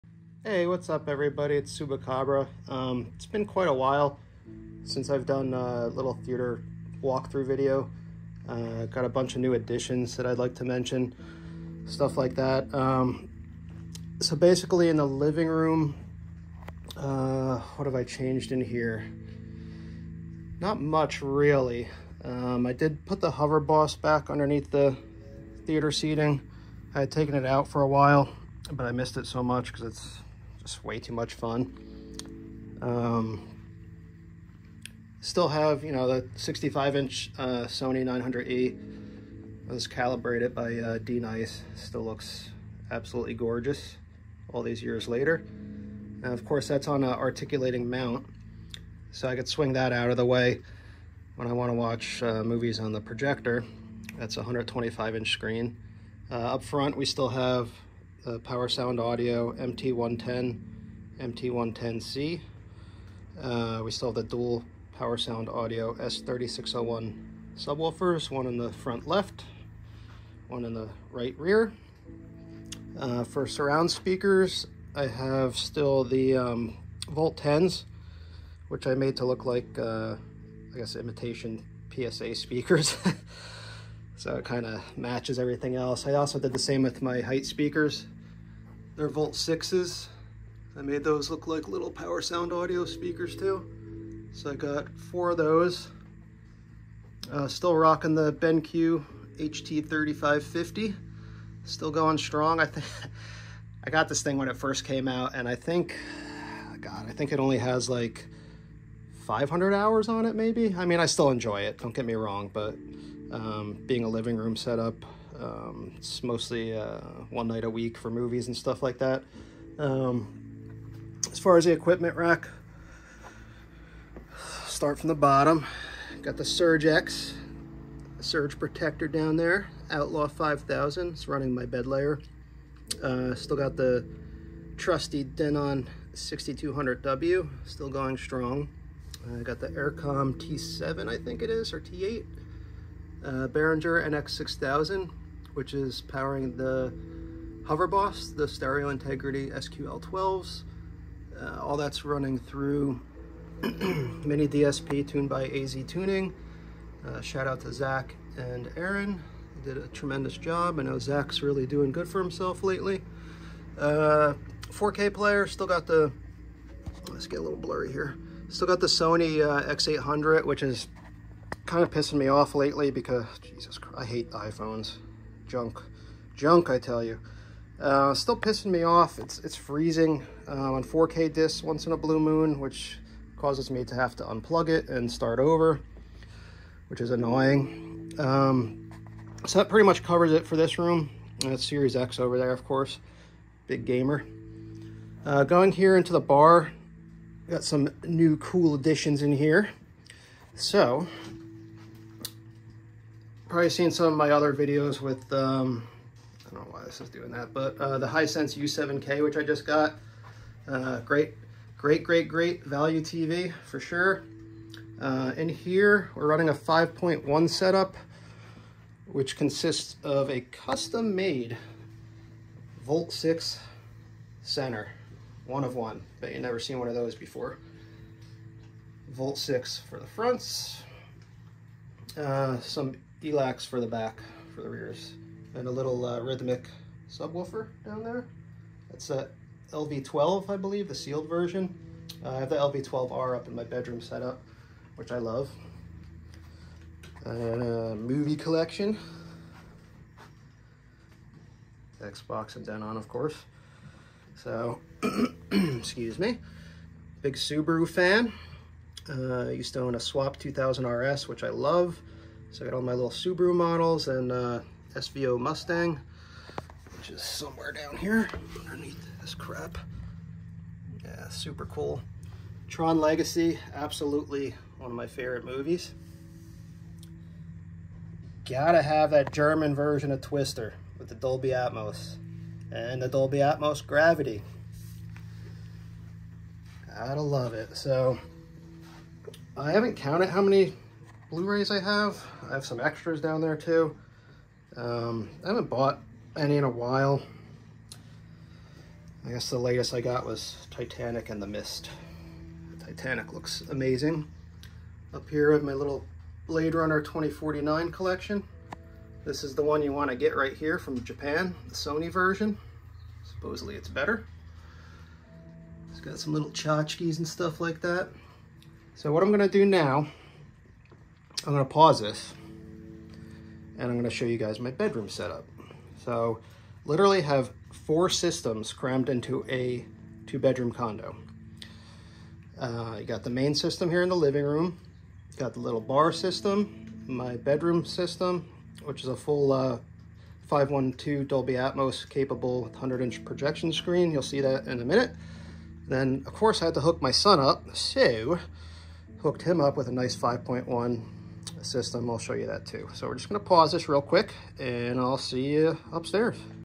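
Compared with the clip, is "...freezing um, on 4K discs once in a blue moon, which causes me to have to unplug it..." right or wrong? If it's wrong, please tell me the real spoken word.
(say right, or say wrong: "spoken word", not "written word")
right.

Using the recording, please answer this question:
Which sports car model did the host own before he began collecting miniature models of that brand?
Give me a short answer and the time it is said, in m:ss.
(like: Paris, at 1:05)
2000 RS, at 4:19.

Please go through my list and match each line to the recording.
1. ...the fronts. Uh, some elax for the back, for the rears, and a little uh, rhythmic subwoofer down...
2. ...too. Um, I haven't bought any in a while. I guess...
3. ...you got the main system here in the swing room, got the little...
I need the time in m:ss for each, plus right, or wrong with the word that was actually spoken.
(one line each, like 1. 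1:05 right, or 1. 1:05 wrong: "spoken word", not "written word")
1. 3:49 right
2. 4:53 right
3. 5:32 wrong: "living", not "swing".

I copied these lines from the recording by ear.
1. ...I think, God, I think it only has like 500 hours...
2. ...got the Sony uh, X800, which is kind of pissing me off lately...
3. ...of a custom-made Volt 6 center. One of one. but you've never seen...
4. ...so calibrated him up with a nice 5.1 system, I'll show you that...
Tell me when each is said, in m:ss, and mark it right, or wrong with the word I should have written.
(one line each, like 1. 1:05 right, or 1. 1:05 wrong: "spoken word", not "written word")
1. 1:45 right
2. 2:48 right
3. 3:40 right
4. 5:47 wrong: "hooked", not "calibrated".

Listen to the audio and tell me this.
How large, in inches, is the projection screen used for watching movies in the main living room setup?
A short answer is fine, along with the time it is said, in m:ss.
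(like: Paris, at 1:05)
125-inch, at 0:54.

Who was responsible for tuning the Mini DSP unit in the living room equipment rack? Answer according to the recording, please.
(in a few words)
AZ Tuning.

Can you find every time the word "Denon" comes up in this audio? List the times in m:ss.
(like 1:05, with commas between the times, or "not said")
2:15, 4:12.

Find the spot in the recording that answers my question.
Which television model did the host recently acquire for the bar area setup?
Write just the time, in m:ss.
3:28.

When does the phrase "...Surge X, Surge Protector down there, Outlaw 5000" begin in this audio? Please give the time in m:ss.
2:06.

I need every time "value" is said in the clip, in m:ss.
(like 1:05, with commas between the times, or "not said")
3:32.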